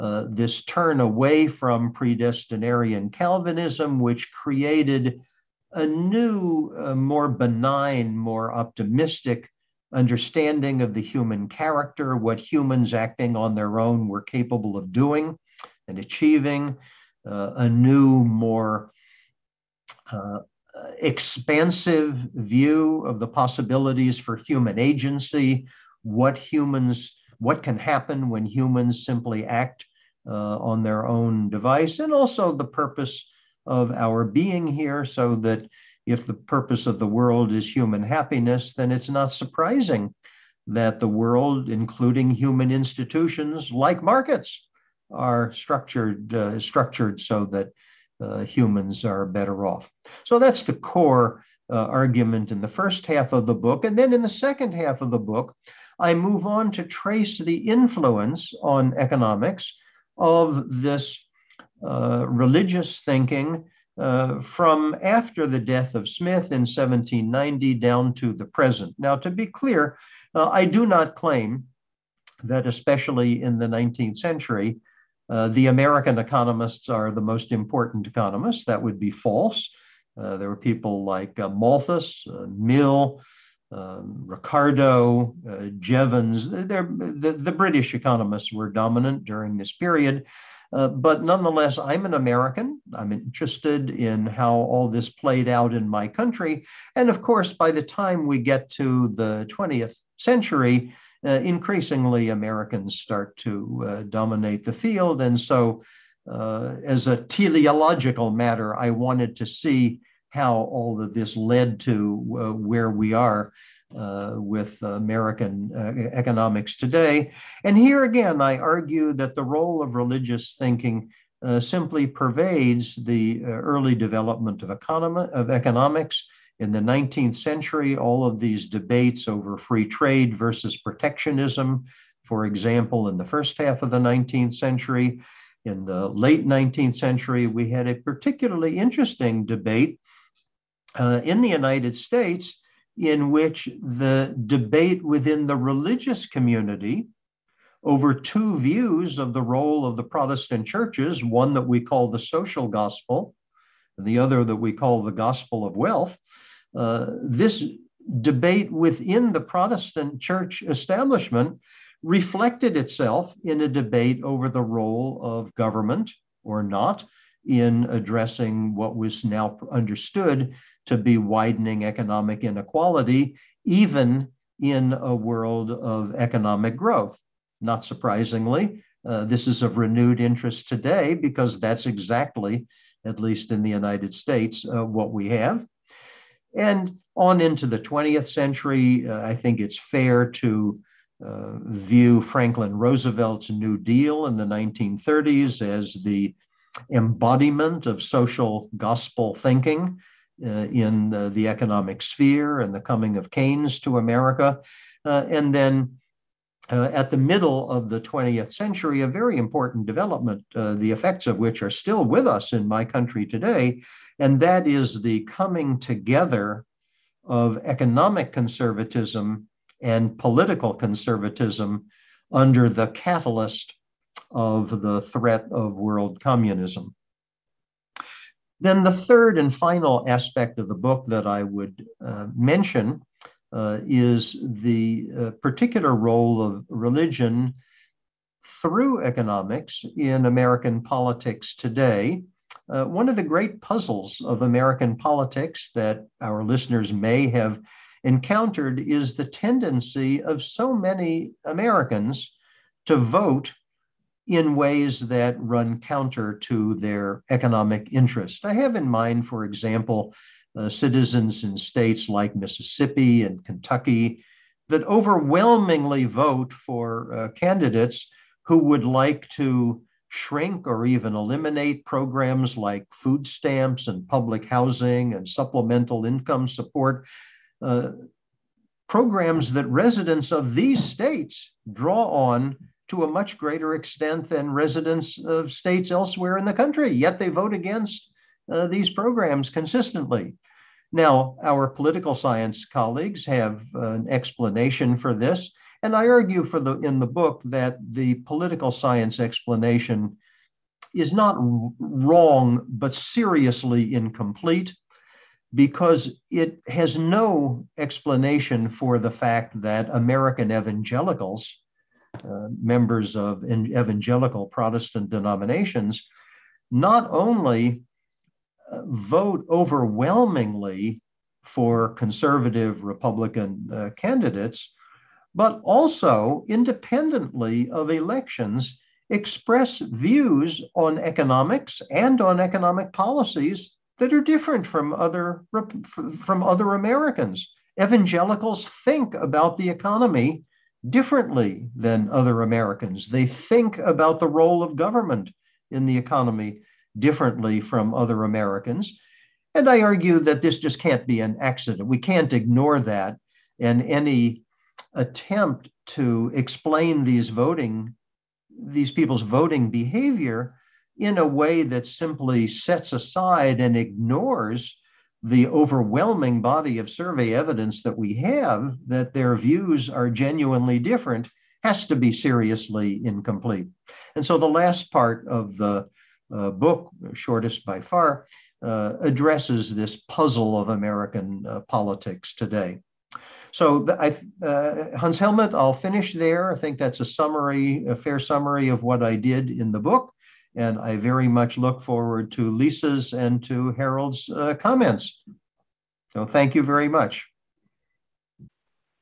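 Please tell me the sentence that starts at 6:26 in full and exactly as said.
I think that's a summary, a fair summary of what I did in the book.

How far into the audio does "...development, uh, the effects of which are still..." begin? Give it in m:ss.
3:29.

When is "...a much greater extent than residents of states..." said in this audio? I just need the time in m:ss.
4:43.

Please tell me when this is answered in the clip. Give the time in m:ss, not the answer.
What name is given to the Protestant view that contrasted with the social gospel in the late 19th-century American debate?
2:35.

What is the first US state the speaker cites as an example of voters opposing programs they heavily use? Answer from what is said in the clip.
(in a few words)
Mississippi.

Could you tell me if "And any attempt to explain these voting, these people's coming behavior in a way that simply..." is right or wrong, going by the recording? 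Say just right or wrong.
wrong.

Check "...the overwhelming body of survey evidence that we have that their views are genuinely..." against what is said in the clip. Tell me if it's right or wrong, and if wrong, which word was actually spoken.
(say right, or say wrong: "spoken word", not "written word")
right.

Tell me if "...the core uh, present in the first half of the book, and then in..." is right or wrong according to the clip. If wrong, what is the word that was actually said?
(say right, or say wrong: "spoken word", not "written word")
wrong: "argument", not "present".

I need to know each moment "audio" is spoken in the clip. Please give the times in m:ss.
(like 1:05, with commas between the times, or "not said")
not said.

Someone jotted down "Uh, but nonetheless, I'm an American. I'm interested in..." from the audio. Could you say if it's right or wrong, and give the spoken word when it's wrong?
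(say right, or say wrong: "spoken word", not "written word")
right.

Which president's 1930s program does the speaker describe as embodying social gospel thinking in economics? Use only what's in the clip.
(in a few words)
Franklin Roosevelt.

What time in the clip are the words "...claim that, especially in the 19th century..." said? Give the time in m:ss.
1:11.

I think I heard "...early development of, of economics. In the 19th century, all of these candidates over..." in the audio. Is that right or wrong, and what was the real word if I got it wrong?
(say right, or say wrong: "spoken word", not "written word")
wrong: "debates", not "candidates".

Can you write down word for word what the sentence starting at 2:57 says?
Not surprisingly, uh, this is of renewed interest today because that's exactly, at least in the United States, uh, what we have.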